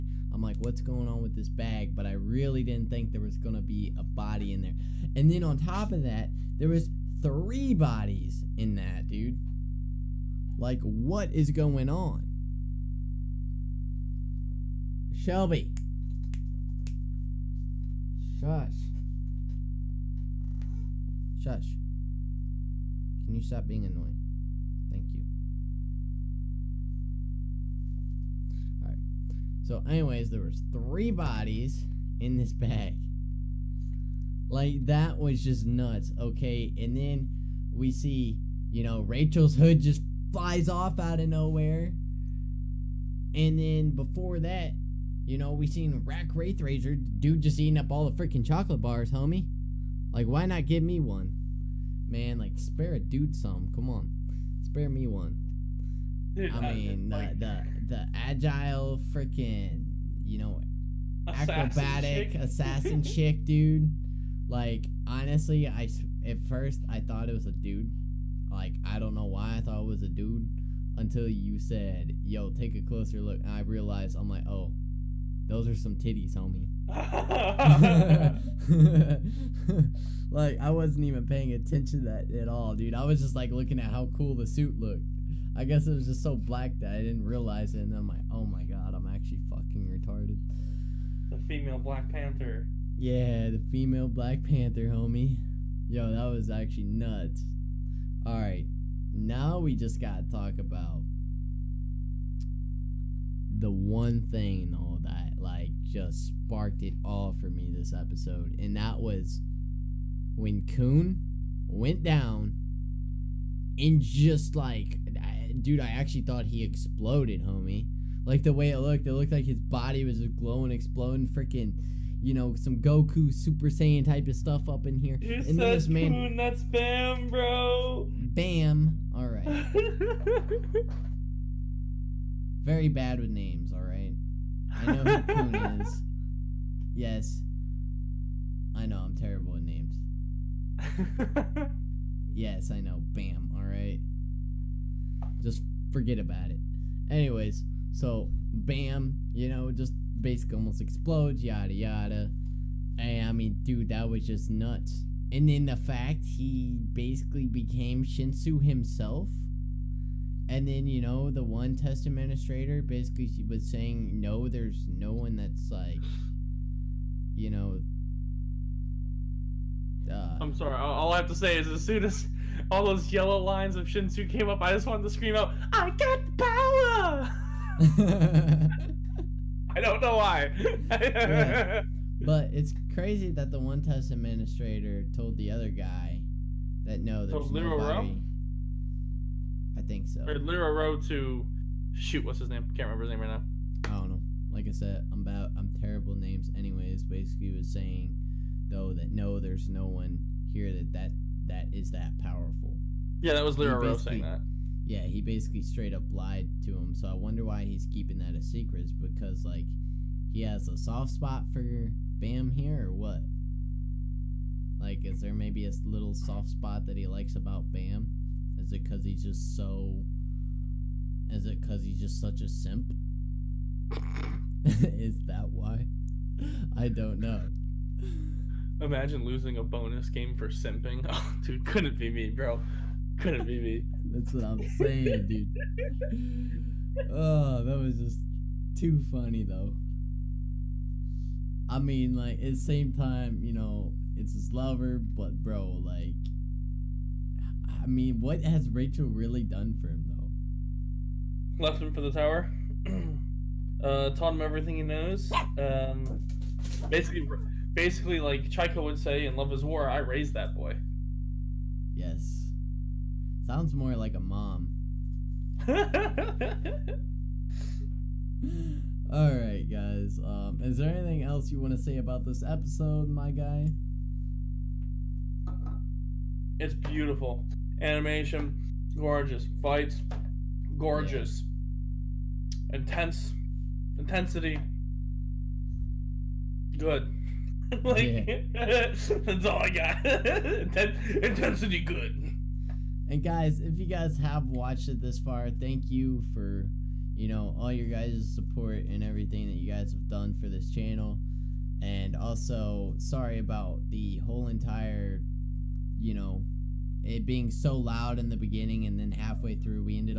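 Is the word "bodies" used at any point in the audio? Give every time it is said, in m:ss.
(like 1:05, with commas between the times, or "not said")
0:07, 0:31.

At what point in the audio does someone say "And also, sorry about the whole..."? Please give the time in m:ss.
5:01.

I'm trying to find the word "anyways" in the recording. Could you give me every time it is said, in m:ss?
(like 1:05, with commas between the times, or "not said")
0:29, 2:27, 3:16.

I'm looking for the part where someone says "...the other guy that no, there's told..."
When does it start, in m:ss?
3:05.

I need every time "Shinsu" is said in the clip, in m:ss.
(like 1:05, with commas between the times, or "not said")
2:38, 2:53.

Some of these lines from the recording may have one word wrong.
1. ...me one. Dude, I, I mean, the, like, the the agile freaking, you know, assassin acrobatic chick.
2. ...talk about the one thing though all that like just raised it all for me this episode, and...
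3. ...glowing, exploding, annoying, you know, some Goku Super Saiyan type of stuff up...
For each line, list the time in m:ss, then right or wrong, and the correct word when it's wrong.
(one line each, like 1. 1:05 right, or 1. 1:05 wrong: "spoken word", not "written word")
1. 0:54 right
2. 1:40 wrong: "sparked", not "raised"
3. 2:00 wrong: "freaking", not "annoying".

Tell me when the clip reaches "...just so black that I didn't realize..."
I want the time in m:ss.
1:26.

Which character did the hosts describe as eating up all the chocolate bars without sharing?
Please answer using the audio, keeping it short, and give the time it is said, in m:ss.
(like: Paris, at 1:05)
Rak Wraithraiser, at 0:46.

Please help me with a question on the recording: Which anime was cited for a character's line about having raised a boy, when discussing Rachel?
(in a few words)
Love is War.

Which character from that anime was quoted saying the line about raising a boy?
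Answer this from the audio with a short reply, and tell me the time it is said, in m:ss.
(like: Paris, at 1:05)
Chika, at 4:18.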